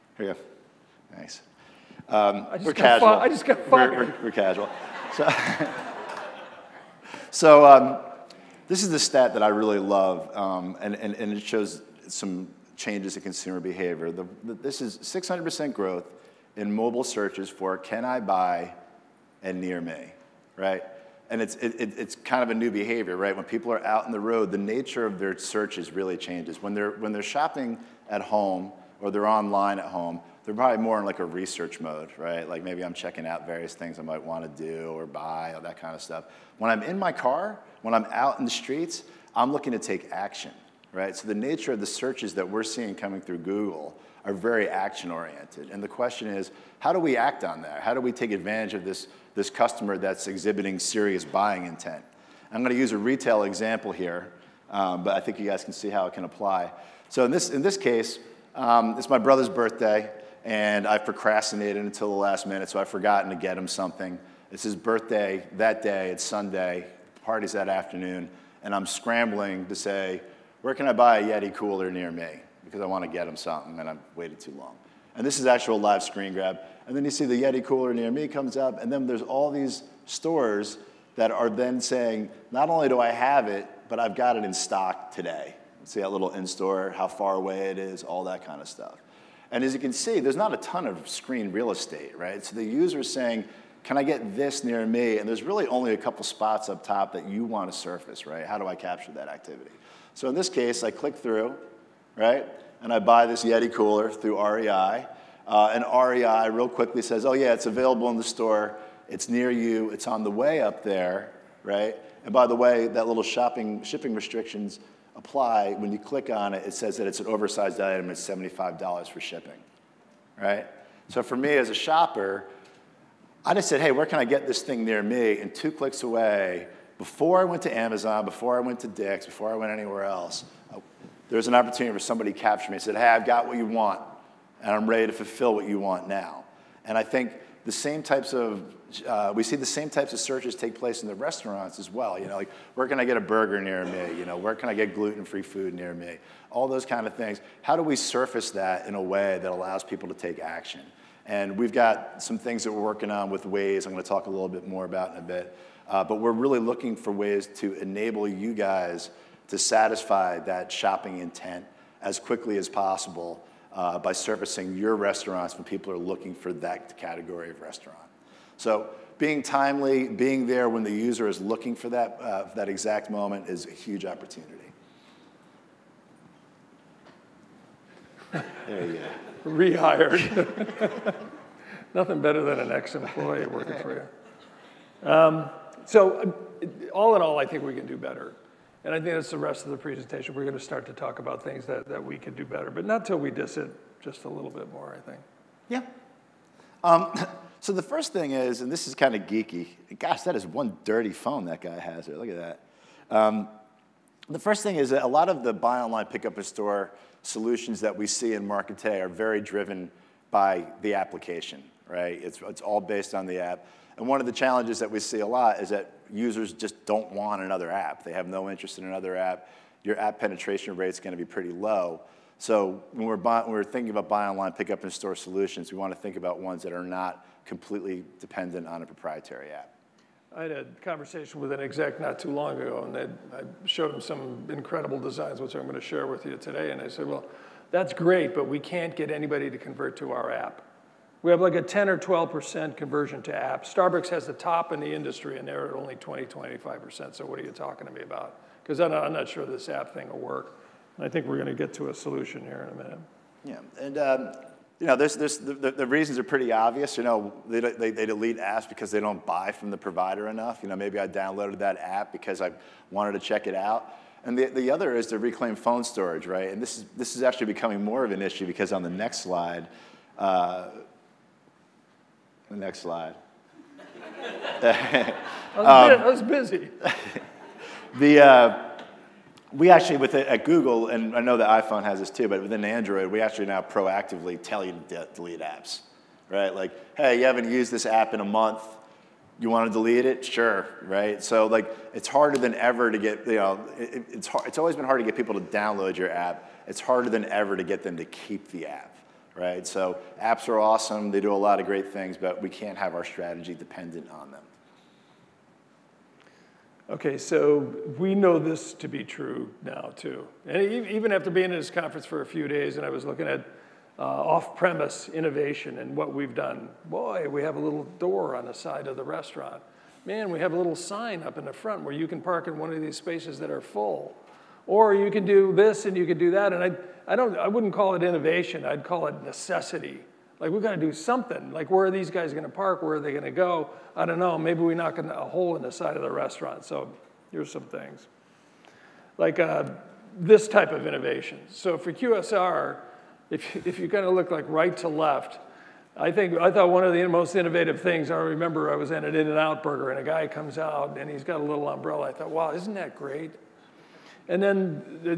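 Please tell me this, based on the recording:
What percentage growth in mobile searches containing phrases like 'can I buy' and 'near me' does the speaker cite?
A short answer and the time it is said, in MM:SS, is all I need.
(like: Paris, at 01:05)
600%, at 00:14.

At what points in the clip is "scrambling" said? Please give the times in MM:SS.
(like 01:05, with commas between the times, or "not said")
01:08.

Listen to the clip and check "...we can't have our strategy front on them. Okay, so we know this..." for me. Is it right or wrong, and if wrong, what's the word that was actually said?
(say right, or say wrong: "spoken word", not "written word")
wrong: "dependent", not "front".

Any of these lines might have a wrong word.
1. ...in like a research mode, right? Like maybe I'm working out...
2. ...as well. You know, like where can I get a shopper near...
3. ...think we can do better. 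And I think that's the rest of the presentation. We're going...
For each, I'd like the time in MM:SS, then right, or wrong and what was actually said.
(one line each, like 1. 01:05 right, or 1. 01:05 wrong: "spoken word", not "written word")
1. 00:30 wrong: "checking", not "working"
2. 02:21 wrong: "burger", not "shopper"
3. 03:07 right.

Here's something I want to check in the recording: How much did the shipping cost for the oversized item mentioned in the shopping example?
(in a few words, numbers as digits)
$75.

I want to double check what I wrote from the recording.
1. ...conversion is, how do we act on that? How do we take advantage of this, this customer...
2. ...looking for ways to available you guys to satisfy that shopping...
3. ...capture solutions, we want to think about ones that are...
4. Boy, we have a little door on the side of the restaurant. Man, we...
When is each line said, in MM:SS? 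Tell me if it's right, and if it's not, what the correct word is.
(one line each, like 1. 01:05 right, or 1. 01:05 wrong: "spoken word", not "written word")
1. 00:45 wrong: "question", not "conversion"
2. 02:36 wrong: "enable", not "available"
3. 03:44 wrong: "store", not "capture"
4. 05:16 right.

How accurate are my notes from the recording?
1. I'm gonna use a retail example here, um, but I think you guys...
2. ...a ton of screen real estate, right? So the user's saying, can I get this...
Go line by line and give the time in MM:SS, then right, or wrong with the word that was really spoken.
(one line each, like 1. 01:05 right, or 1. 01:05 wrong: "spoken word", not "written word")
1. 00:52 right
2. 01:30 right.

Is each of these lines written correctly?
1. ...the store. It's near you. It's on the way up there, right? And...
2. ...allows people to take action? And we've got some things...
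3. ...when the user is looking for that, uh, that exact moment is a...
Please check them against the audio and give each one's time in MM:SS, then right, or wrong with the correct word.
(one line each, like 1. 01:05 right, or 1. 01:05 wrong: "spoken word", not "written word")
1. 01:48 right
2. 02:29 right
3. 02:50 right.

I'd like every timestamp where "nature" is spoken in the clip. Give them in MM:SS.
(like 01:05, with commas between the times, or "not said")
00:24, 00:41.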